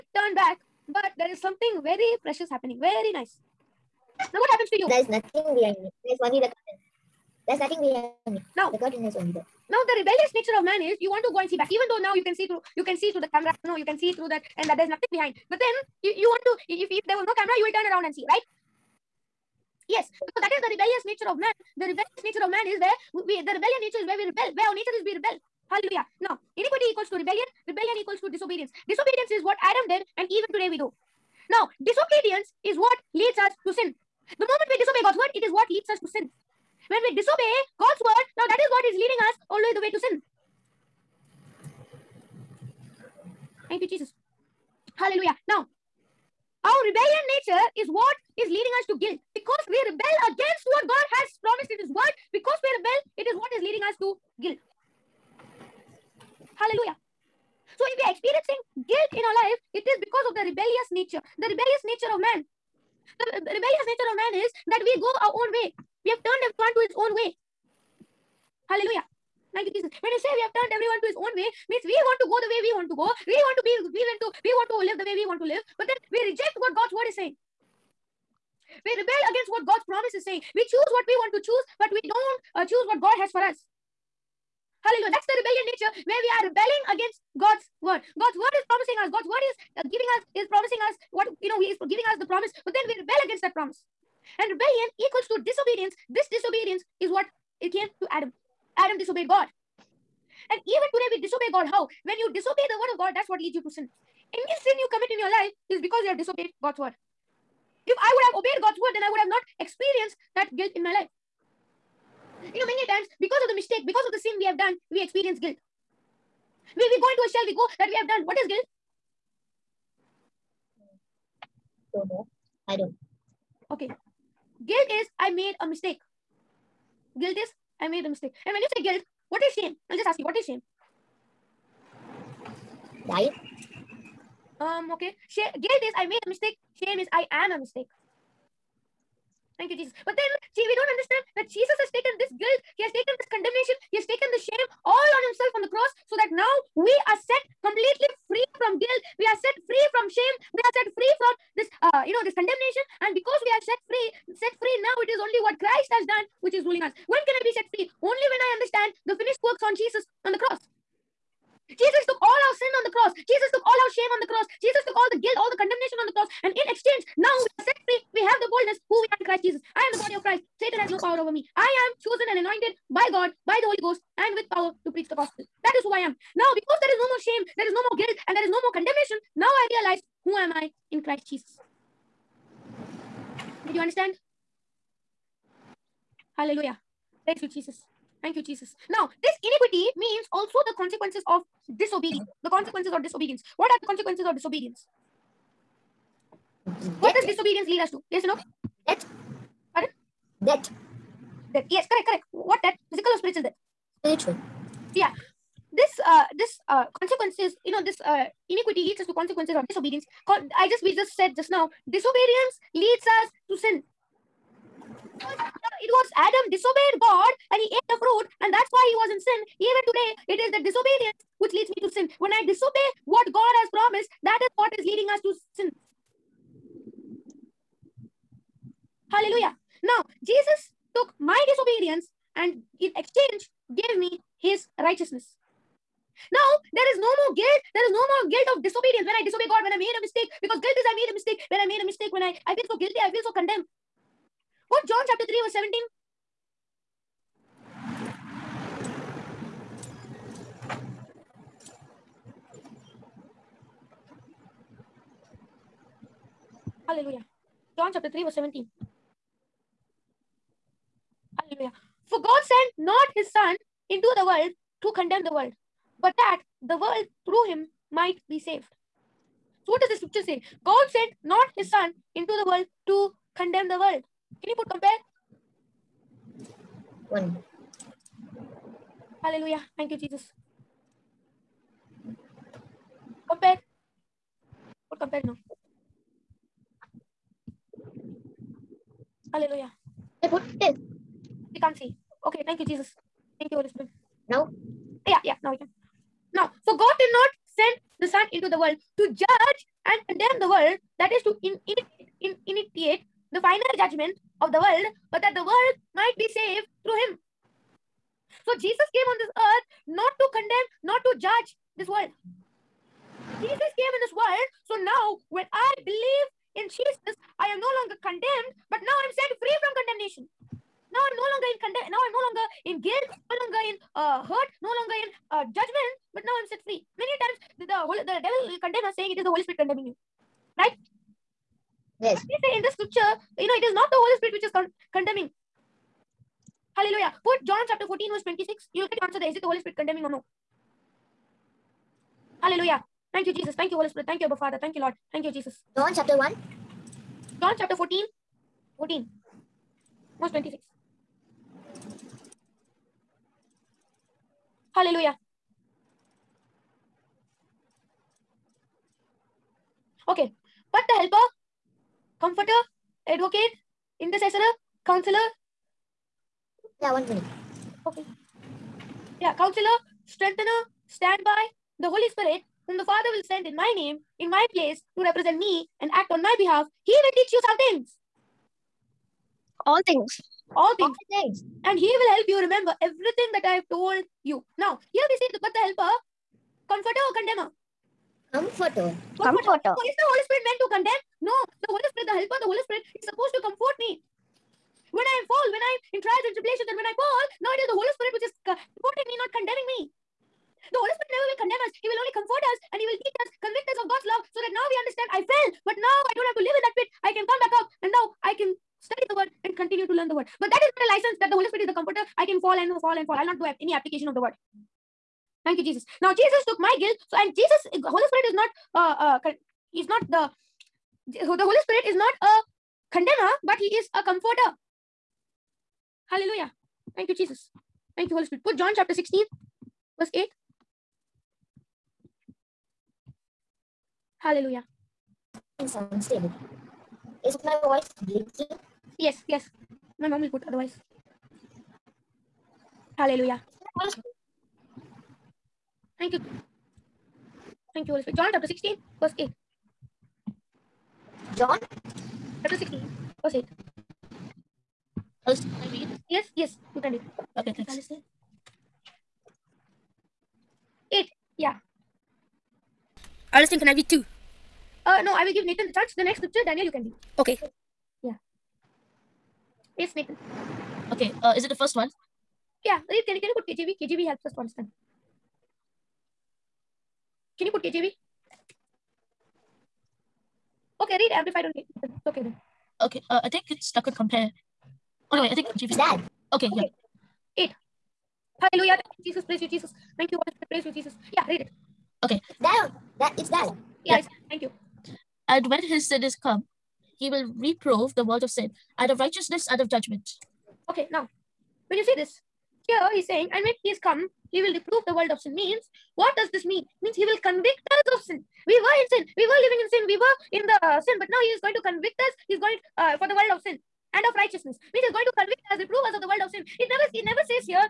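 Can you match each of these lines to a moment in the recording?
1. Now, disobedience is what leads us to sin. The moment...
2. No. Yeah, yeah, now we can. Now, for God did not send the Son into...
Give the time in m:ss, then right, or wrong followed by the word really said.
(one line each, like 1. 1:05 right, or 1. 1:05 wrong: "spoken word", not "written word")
1. 0:31 right
2. 4:54 right.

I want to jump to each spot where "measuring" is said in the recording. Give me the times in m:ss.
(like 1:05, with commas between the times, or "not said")
not said.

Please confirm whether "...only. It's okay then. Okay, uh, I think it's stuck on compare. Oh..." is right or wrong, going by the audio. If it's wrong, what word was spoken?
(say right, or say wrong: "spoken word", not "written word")
right.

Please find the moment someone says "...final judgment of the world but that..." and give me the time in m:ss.
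5:03.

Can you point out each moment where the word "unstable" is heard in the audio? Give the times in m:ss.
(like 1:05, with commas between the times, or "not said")
7:15.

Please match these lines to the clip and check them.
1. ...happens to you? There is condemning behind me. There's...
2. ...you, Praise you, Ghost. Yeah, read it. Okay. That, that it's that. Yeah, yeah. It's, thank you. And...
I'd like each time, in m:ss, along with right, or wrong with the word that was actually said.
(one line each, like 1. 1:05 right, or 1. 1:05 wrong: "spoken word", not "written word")
1. 0:04 wrong: "nothing", not "condemning"
2. 8:10 wrong: "Jesus", not "Ghost".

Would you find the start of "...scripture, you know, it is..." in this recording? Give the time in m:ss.
5:32.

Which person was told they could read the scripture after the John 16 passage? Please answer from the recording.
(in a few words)
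Daniel.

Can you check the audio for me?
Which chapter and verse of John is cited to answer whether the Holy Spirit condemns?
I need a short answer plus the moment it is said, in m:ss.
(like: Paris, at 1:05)
14:26, at 5:37.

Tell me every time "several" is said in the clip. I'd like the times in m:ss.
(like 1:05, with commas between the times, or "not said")
not said.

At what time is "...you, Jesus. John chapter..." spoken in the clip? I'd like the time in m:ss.
5:45.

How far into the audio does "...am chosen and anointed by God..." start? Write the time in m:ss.
2:51.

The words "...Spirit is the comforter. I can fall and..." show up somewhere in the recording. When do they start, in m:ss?
6:51.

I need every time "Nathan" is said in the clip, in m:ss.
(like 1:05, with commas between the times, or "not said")
7:45, 7:49.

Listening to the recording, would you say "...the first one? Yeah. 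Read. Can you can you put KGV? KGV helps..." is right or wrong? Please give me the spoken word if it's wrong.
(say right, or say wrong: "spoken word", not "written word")
right.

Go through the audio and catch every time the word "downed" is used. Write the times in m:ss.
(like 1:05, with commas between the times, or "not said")
not said.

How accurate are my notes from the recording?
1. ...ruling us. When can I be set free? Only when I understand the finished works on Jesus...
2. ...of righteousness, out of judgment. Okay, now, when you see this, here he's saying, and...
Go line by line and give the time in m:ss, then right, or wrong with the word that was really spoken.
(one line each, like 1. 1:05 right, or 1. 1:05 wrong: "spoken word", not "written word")
1. 2:36 right
2. 8:18 right.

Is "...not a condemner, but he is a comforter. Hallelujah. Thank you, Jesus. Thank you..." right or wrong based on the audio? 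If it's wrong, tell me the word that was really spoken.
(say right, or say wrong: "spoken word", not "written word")
right.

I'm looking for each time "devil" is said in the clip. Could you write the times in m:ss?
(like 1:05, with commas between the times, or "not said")
5:28.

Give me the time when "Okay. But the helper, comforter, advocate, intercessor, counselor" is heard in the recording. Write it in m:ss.
6:00.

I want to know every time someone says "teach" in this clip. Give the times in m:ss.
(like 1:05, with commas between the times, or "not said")
6:17, 6:42.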